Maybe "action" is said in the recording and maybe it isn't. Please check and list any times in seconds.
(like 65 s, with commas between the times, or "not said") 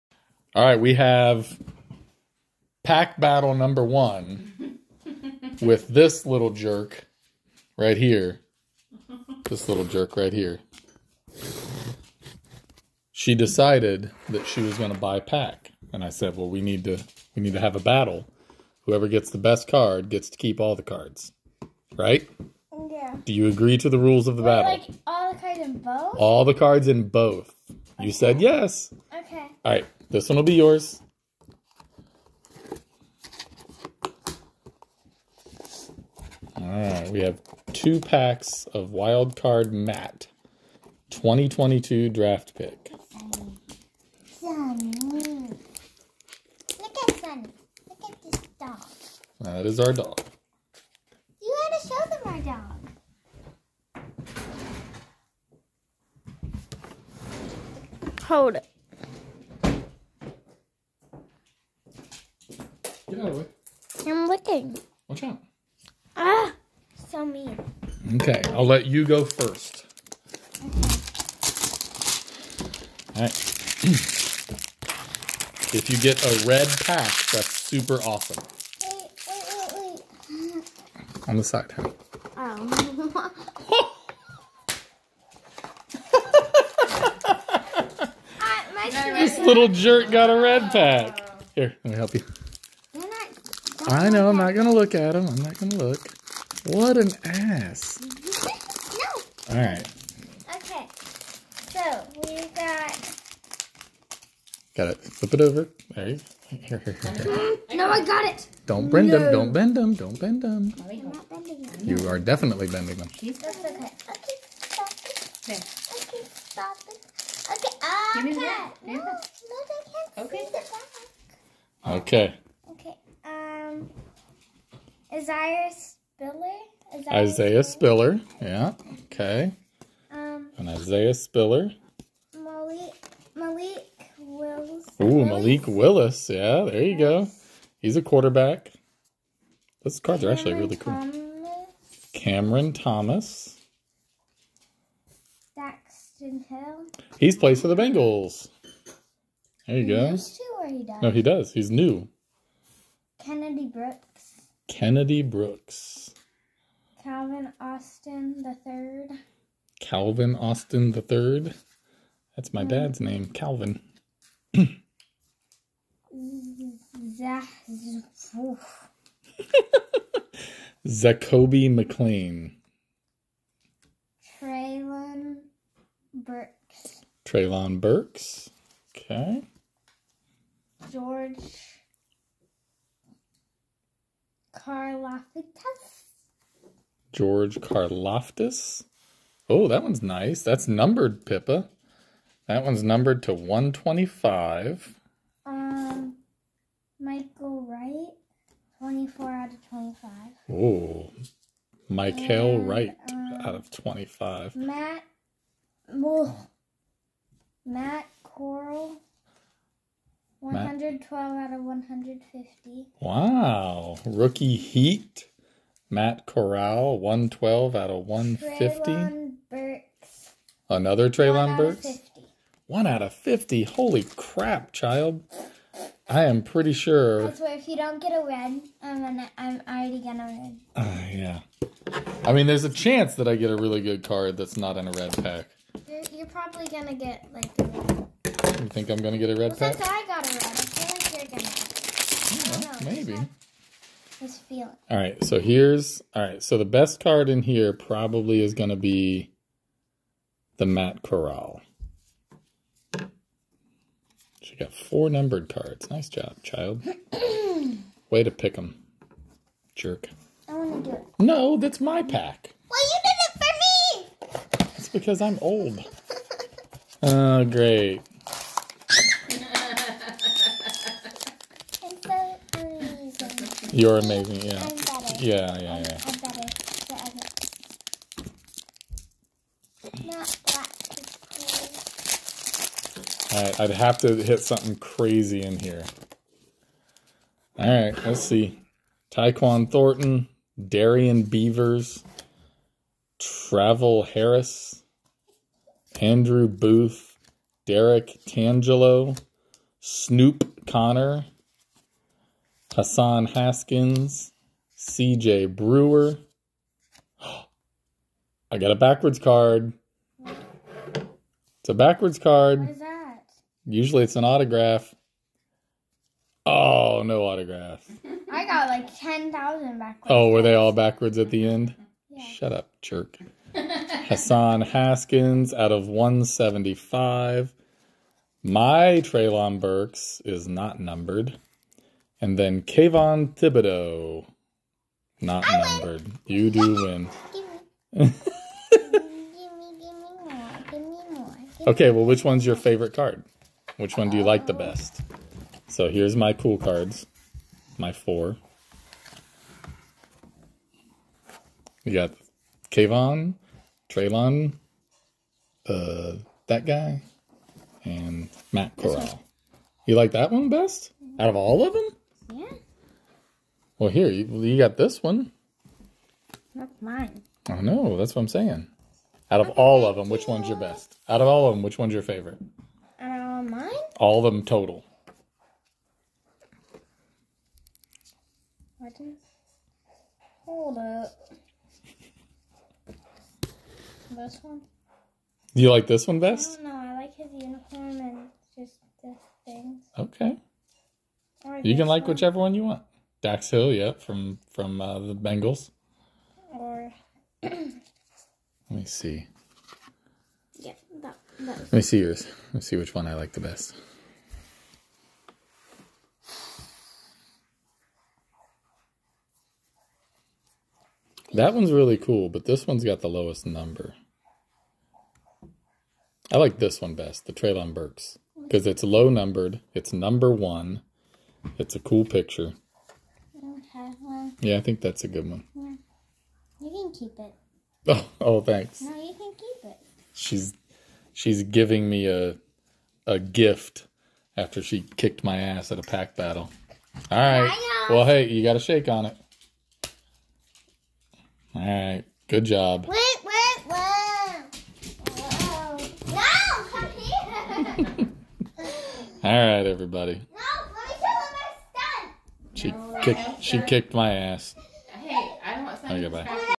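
not said.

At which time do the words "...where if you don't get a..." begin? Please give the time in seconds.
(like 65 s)
227 s.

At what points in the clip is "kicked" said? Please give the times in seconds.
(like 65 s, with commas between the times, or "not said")
434 s, 453 s.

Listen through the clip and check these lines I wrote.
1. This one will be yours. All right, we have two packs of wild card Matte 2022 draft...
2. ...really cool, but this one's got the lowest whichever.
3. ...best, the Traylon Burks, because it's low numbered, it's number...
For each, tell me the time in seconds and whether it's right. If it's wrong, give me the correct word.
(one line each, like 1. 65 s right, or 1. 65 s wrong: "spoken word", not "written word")
1. 30 s right
2. 411 s wrong: "number", not "whichever"
3. 416 s right.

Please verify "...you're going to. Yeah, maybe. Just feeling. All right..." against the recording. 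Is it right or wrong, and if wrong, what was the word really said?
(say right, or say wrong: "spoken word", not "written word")
right.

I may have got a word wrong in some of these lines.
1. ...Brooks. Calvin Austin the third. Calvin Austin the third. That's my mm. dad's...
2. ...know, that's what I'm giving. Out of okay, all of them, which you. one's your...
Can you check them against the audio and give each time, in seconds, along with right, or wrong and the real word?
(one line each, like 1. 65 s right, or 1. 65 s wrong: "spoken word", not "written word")
1. 155 s right
2. 367 s wrong: "saying", not "giving".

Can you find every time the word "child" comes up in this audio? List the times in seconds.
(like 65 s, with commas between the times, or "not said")
224 s, 256 s.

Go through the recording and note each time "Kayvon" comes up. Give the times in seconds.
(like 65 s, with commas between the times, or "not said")
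332 s, 352 s.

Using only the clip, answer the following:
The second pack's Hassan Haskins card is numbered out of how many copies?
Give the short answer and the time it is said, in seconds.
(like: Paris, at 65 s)
175, at 325 s.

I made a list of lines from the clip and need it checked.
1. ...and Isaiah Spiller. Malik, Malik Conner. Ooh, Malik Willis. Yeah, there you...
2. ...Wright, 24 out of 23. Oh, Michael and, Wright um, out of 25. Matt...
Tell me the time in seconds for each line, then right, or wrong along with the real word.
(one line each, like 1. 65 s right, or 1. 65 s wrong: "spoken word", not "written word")
1. 130 s wrong: "Willis", not "Conner"
2. 197 s wrong: "25", not "23".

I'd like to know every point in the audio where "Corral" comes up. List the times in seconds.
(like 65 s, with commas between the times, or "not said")
208 s, 216 s, 251 s, 358 s.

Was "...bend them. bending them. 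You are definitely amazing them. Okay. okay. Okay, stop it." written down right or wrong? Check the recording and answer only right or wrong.
wrong.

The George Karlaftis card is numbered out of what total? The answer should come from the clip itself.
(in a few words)
125.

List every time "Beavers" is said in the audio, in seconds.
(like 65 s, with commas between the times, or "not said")
291 s.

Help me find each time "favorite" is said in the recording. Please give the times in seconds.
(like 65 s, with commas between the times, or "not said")
342 s, 372 s.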